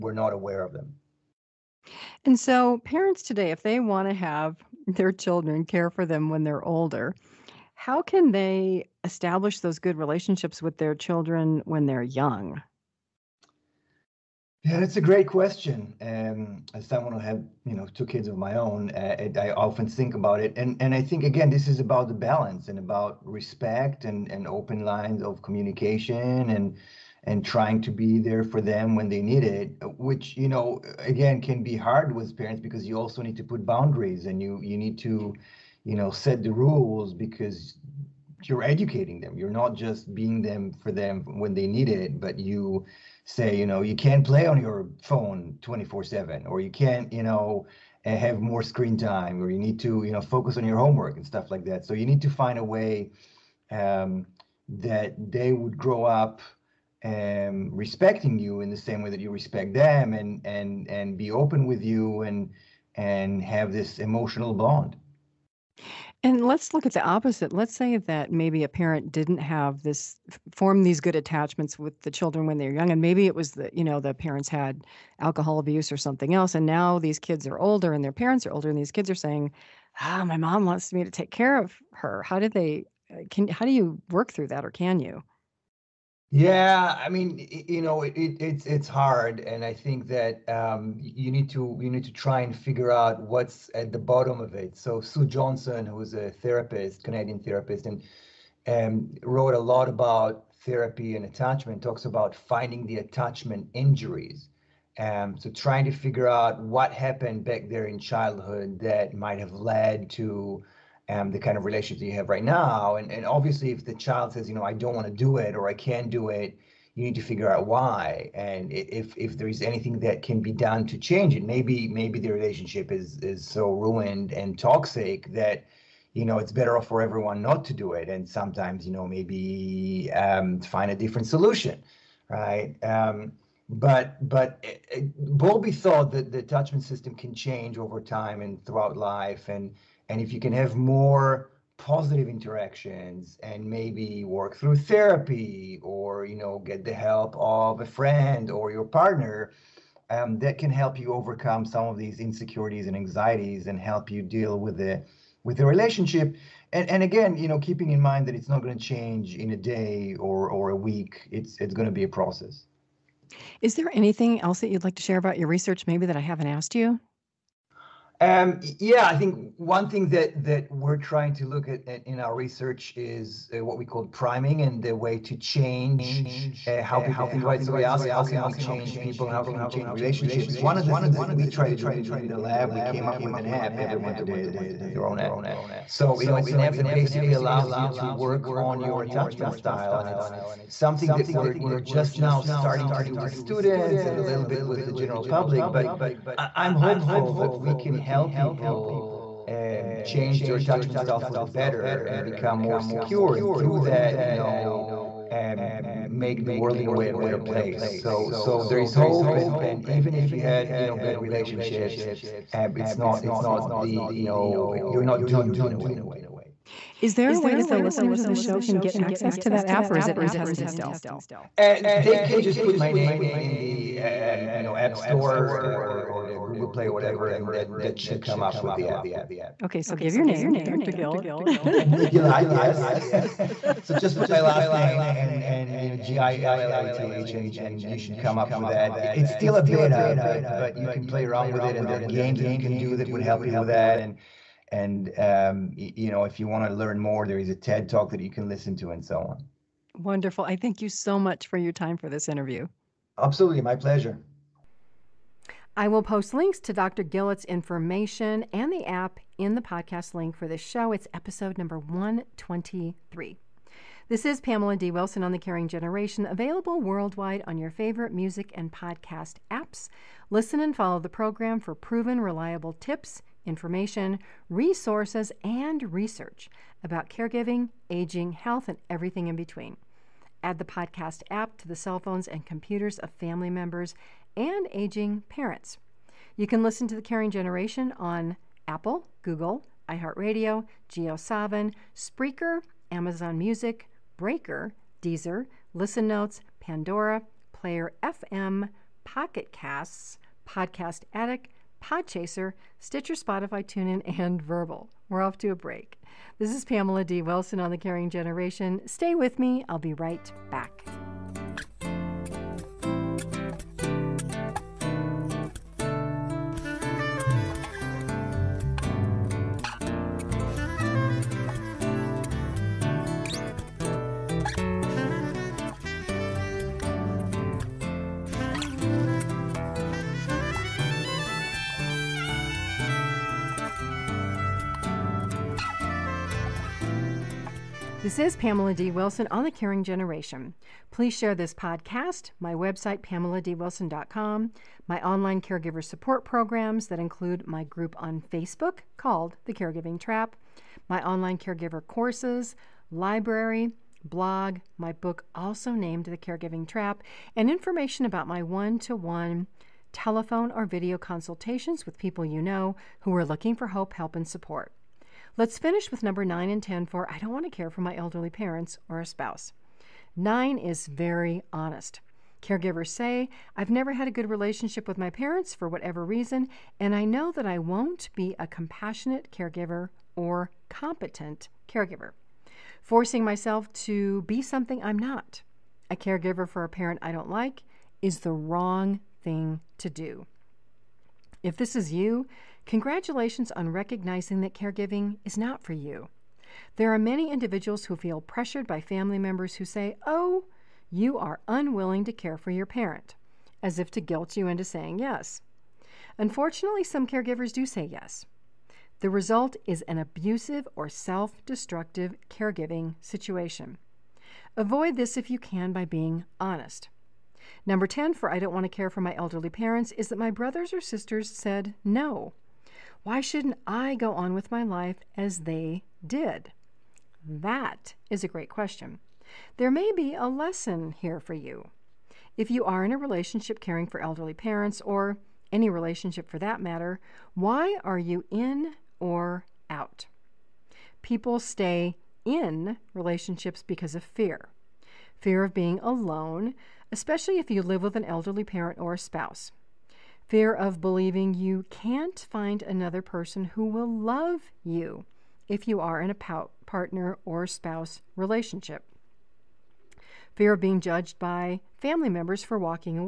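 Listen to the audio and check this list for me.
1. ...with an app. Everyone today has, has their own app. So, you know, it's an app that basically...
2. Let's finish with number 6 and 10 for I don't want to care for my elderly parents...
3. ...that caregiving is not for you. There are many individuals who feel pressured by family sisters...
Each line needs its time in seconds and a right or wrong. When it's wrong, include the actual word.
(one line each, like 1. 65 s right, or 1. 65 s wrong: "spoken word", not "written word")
1. 183 s right
2. 365 s wrong: "9", not "6"
3. 394 s wrong: "members", not "sisters".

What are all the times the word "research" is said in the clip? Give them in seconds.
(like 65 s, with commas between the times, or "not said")
165 s, 172 s, 275 s.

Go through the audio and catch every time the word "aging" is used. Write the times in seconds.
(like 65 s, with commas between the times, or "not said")
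277 s, 284 s.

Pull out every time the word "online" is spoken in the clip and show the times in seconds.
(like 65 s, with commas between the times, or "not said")
345 s, 351 s.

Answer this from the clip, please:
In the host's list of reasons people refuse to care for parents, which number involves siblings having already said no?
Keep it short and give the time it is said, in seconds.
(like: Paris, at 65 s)
10, at 417 s.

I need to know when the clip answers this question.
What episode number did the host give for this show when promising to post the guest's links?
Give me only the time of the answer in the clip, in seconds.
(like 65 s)
261 s.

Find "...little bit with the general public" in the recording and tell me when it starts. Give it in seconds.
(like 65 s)
194 s.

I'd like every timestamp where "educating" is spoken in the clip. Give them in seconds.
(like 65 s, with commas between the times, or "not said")
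38 s.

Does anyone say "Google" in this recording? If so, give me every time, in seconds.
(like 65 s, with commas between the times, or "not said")
226 s, 289 s.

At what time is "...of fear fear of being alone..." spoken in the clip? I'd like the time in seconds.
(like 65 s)
443 s.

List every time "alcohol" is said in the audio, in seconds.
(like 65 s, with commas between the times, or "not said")
75 s.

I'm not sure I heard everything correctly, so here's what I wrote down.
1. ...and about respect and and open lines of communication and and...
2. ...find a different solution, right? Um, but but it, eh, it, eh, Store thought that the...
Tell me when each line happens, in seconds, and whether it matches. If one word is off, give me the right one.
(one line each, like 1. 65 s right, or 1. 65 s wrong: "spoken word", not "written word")
1. 22 s right
2. 130 s wrong: "Bowlby", not "Store".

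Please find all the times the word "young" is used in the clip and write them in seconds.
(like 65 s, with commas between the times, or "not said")
12 s, 72 s.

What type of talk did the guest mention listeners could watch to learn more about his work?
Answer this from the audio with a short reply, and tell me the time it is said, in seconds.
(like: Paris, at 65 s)
TED talk, at 247 s.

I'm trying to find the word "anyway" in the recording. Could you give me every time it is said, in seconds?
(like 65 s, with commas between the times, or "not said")
not said.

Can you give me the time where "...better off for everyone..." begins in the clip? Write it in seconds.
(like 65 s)
126 s.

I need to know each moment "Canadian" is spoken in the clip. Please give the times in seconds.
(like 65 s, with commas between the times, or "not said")
97 s.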